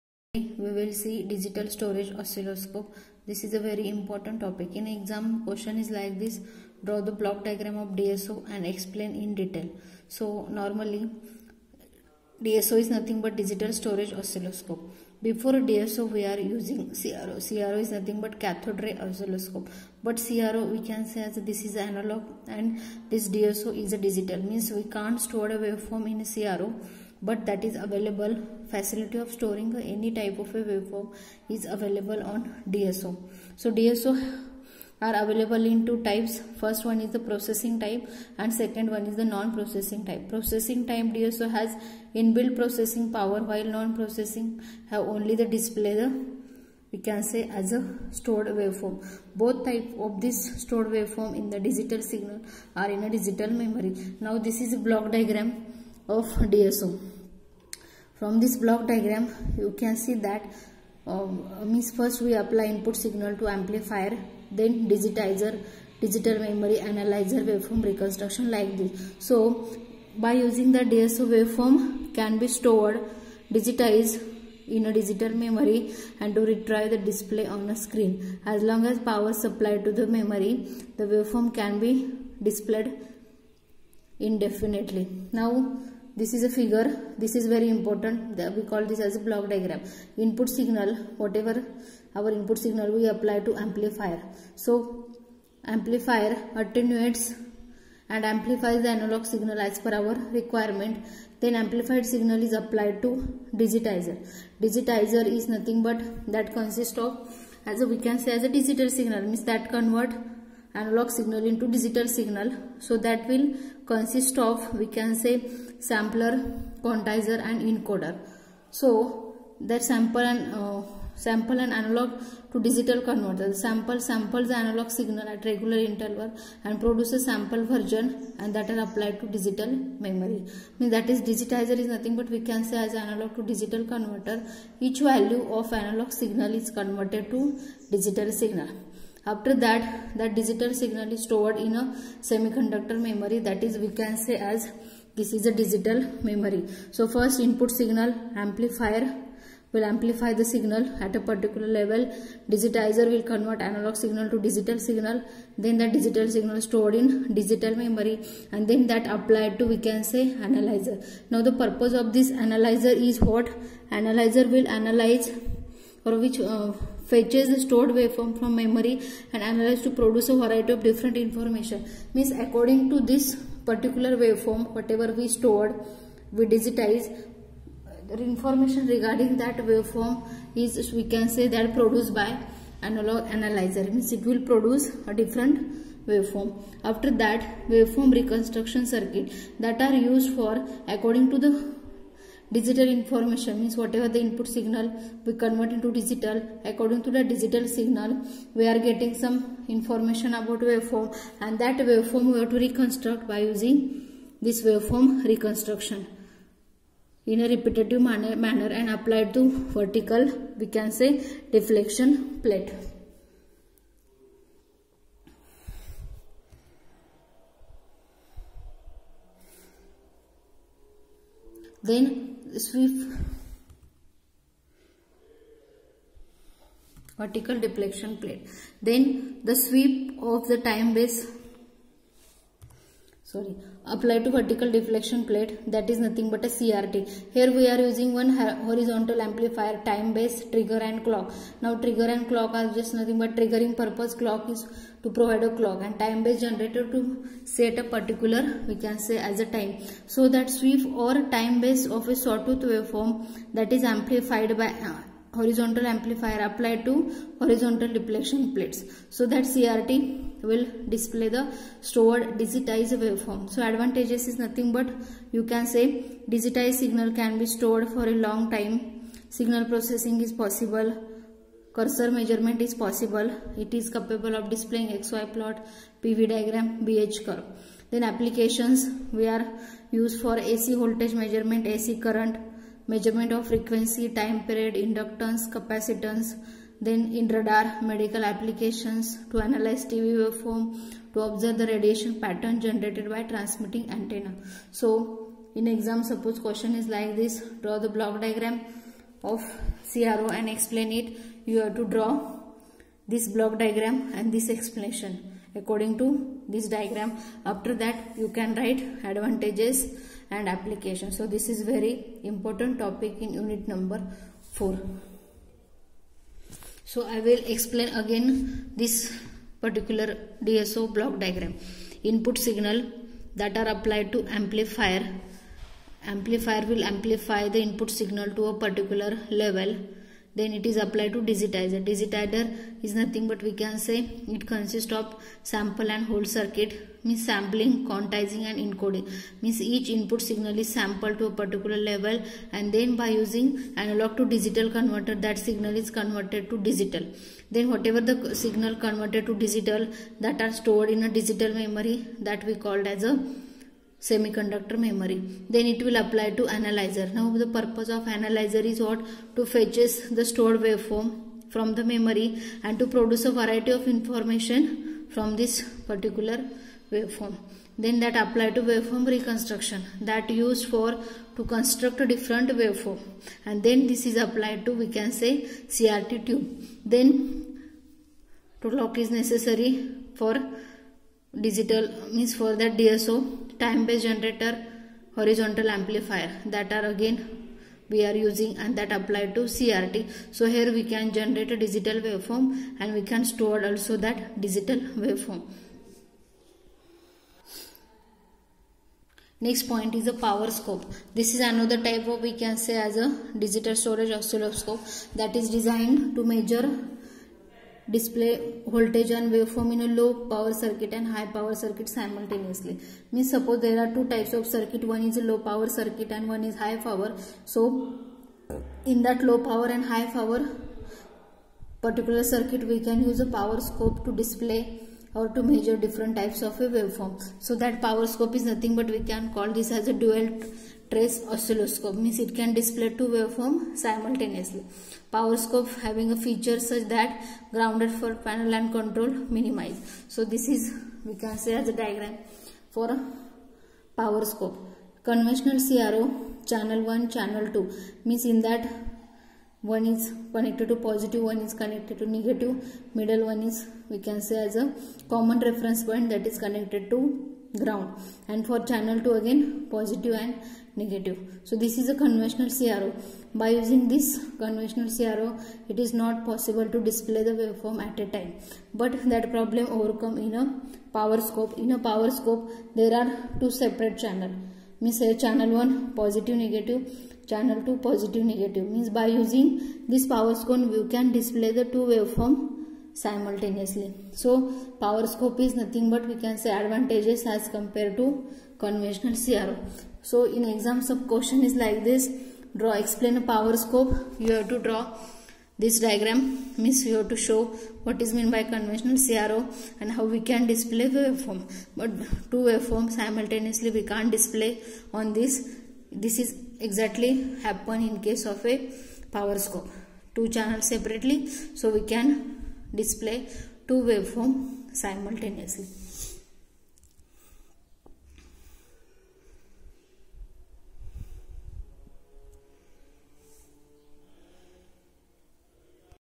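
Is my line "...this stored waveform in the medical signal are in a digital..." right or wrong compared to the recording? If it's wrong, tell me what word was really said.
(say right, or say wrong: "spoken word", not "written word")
wrong: "digital", not "medical".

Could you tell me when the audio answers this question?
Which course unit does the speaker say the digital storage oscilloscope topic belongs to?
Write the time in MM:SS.
05:13.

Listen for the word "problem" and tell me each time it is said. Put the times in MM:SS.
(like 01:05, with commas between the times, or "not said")
07:49.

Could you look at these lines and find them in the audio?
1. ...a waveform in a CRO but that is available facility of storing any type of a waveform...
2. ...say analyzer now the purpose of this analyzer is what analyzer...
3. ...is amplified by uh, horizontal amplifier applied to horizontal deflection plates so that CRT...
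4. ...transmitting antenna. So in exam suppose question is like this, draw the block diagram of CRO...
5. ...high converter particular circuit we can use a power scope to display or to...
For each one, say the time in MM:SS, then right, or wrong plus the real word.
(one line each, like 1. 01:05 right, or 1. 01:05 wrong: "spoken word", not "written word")
1. 00:25 right
2. 02:40 right
3. 04:13 right
4. 04:53 right
5. 06:59 wrong: "power", not "converter".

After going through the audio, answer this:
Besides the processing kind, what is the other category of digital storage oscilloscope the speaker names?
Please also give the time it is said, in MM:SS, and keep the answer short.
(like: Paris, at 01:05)
Non-processing type, at 00:39.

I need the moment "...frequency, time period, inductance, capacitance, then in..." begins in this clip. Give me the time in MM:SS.
04:43.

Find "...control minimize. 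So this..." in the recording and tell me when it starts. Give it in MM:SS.
07:18.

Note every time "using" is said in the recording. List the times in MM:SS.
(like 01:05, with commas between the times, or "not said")
00:16, 01:10, 03:23, 03:57, 05:43, 06:28, 07:43, 07:59.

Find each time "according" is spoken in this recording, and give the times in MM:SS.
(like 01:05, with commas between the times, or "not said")
02:52, 03:10, 03:16, 05:05.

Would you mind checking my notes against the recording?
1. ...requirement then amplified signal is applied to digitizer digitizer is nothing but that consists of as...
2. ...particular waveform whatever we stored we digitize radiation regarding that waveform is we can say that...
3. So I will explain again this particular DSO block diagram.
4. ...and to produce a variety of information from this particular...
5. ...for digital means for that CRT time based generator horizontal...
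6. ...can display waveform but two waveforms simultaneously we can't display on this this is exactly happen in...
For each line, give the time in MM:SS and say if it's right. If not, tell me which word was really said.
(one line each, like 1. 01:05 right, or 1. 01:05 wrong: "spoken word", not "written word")
1. 01:40 right
2. 02:53 wrong: "information", not "radiation"
3. 05:16 right
4. 06:02 right
5. 06:20 wrong: "DSO", not "CRT"
6. 08:20 right.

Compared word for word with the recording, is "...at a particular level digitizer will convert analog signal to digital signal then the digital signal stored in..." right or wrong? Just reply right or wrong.
right.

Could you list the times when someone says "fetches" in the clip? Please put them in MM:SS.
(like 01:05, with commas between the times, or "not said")
02:47, 05:59.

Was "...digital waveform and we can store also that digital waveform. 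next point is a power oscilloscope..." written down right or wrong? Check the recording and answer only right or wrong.
wrong.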